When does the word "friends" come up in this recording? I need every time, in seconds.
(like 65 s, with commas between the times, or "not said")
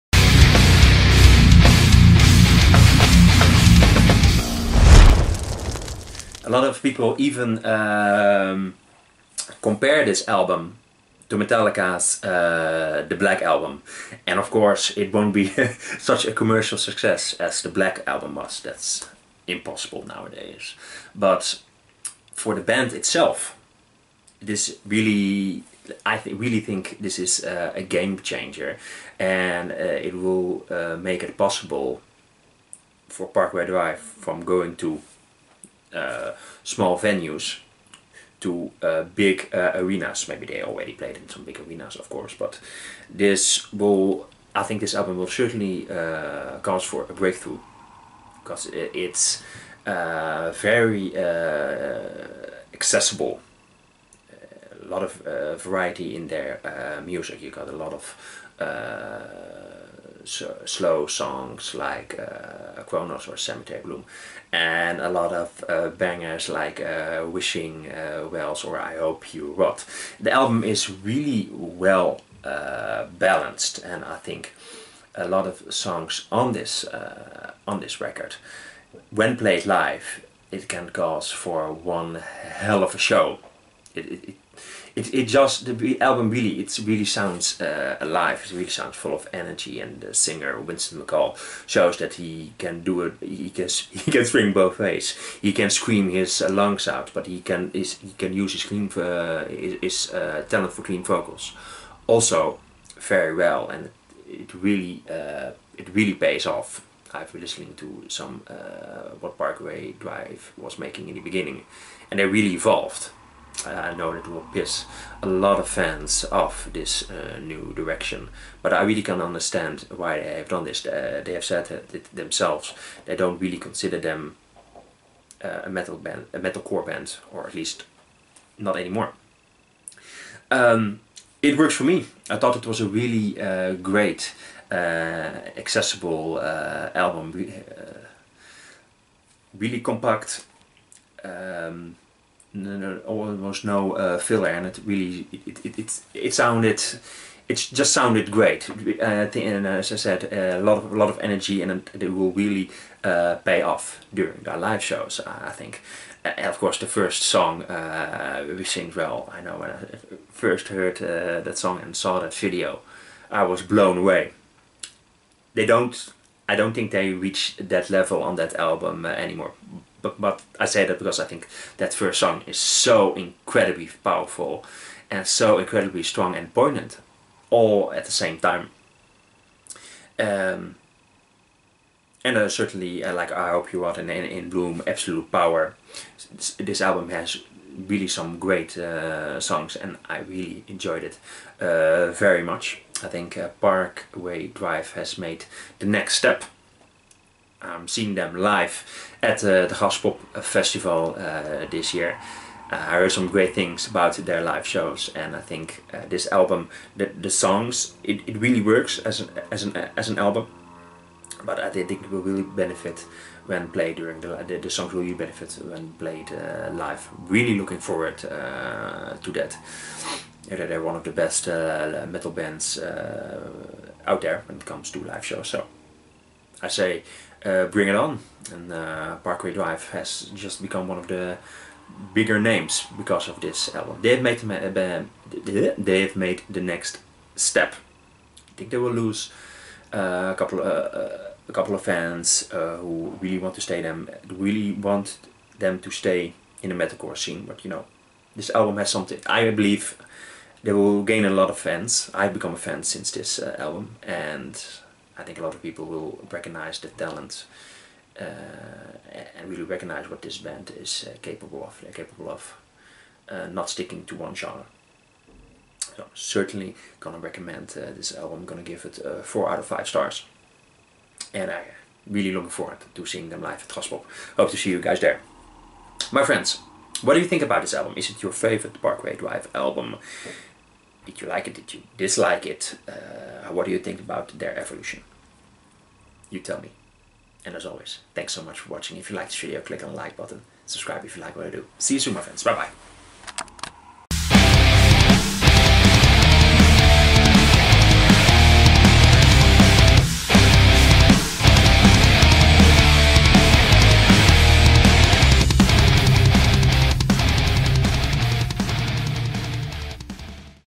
276 s, 292 s.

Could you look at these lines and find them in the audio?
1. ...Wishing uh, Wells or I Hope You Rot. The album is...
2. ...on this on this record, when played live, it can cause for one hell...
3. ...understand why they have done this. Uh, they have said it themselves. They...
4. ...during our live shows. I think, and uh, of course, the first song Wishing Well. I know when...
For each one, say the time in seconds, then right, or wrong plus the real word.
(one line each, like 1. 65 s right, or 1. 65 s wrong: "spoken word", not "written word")
1. 67 s right
2. 76 s right
3. 119 s right
4. 154 s right.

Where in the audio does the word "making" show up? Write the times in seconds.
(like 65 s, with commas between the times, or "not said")
110 s.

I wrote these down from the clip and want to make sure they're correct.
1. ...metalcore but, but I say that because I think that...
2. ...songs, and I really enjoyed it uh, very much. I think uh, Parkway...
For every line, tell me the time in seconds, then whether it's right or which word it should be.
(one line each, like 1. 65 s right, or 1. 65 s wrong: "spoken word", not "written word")
1. 169 s wrong: "anymore", not "metalcore"
2. 189 s right.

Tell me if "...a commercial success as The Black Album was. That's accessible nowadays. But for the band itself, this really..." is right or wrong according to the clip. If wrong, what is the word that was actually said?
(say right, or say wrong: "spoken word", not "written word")
wrong: "impossible", not "accessible".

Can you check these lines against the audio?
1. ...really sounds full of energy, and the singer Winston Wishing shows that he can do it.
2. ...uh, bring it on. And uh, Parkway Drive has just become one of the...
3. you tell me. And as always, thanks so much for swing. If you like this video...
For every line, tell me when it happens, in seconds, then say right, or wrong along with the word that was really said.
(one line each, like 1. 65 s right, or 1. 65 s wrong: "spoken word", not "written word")
1. 88 s wrong: "McCall", not "Wishing"
2. 227 s right
3. 286 s wrong: "watching", not "swing".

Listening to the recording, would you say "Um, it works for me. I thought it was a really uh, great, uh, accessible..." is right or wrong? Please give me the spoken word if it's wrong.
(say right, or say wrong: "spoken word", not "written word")
right.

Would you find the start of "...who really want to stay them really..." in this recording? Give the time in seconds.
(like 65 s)
242 s.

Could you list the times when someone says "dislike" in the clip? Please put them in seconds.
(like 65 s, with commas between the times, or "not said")
281 s.